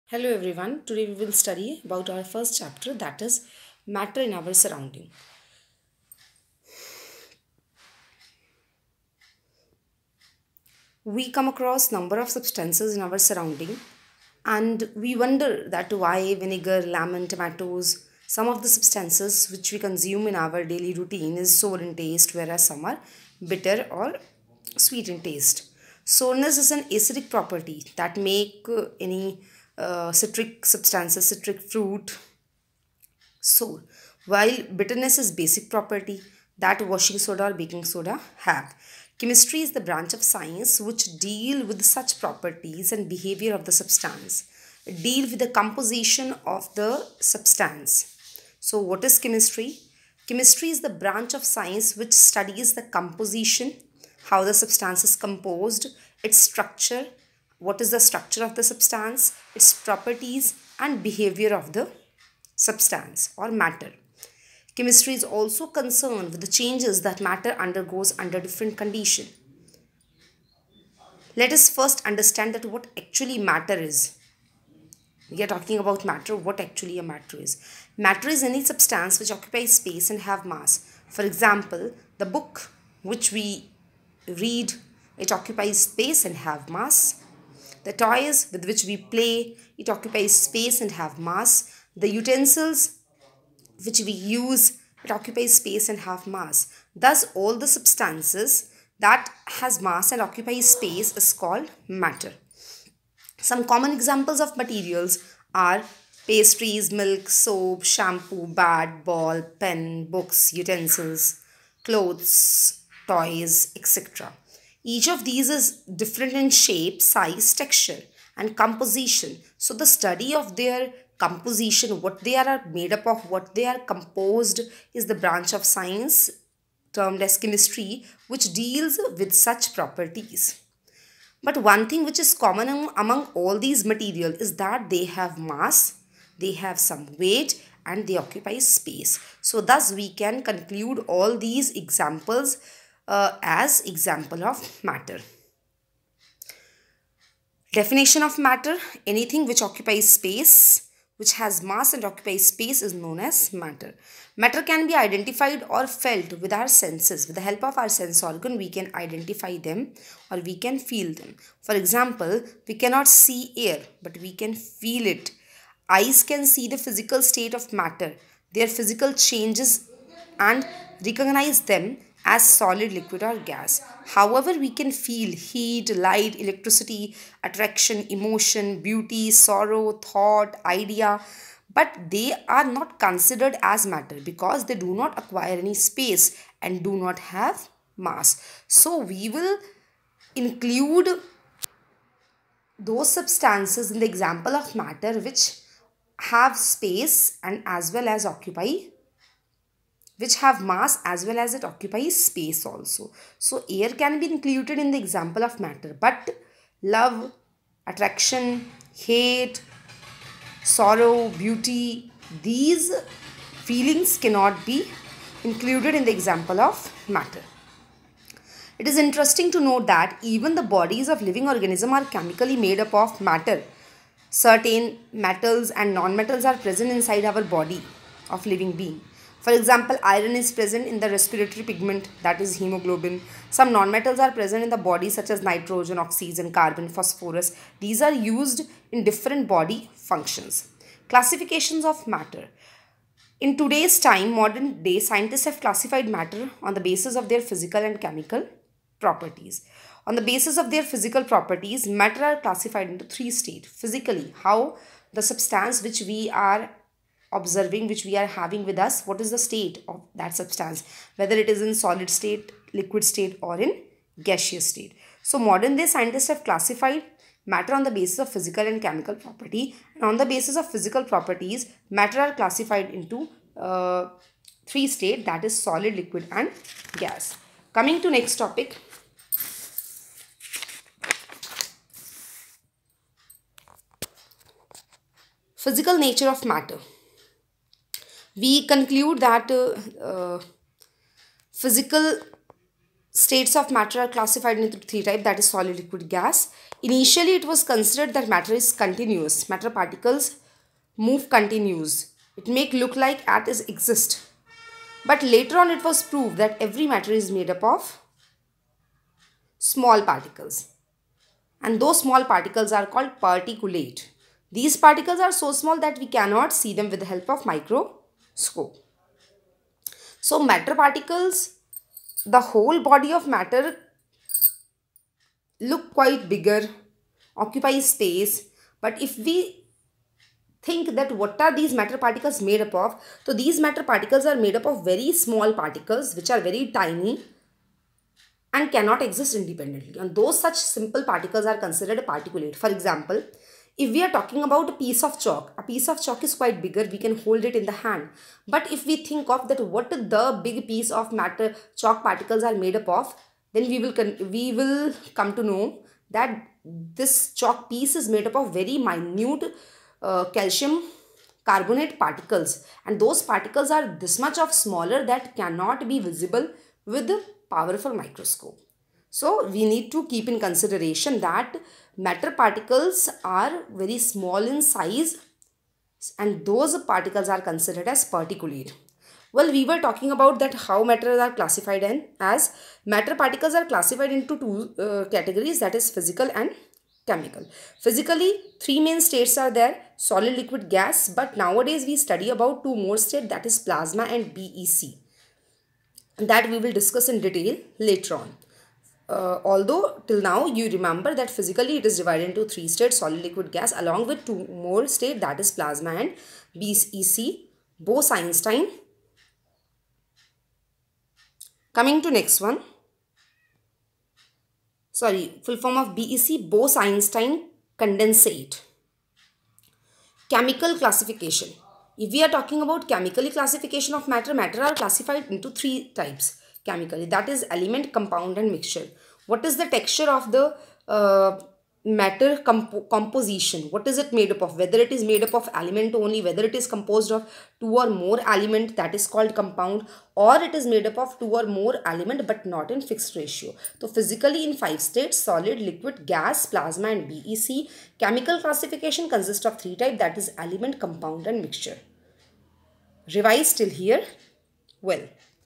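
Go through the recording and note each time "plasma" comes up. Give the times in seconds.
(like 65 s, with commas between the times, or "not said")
393 s, 405 s, 446 s.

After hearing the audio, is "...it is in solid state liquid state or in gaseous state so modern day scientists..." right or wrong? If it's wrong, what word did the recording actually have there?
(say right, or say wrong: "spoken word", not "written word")
right.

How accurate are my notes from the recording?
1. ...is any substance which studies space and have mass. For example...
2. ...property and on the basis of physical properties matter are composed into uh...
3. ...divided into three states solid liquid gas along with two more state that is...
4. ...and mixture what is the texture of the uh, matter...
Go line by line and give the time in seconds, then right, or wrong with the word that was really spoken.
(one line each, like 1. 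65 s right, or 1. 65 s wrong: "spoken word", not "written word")
1. 78 s wrong: "occupies", not "studies"
2. 269 s wrong: "classified", not "composed"
3. 401 s right
4. 428 s right.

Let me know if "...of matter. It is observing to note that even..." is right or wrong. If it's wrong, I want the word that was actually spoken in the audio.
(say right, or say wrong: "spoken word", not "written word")
wrong: "interesting", not "observing".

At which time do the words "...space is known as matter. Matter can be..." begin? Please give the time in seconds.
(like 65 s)
152 s.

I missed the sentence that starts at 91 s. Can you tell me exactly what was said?
The utensils which we use, it occupies space and have mass.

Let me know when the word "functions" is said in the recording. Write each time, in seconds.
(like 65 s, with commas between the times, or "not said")
239 s.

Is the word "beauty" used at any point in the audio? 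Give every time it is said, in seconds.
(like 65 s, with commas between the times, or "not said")
178 s, 211 s.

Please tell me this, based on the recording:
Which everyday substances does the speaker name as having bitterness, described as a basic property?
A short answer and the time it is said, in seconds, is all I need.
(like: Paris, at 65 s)
washing soda or baking soda, at 36 s.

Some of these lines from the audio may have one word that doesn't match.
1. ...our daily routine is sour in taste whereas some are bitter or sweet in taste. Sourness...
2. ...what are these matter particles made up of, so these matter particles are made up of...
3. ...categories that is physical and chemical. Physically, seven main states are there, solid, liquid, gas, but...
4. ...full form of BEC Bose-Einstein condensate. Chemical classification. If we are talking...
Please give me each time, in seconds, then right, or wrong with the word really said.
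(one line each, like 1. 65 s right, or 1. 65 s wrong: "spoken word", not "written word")
1. 20 s right
2. 331 s right
3. 385 s wrong: "three", not "seven"
4. 415 s right.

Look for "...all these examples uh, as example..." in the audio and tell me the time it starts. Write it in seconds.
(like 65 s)
141 s.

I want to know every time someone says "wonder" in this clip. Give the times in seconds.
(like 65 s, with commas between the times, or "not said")
15 s.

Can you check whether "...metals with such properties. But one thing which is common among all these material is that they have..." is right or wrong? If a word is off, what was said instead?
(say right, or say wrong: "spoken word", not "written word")
wrong: "deals", not "metals".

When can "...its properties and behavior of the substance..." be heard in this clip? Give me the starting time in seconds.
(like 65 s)
59 s.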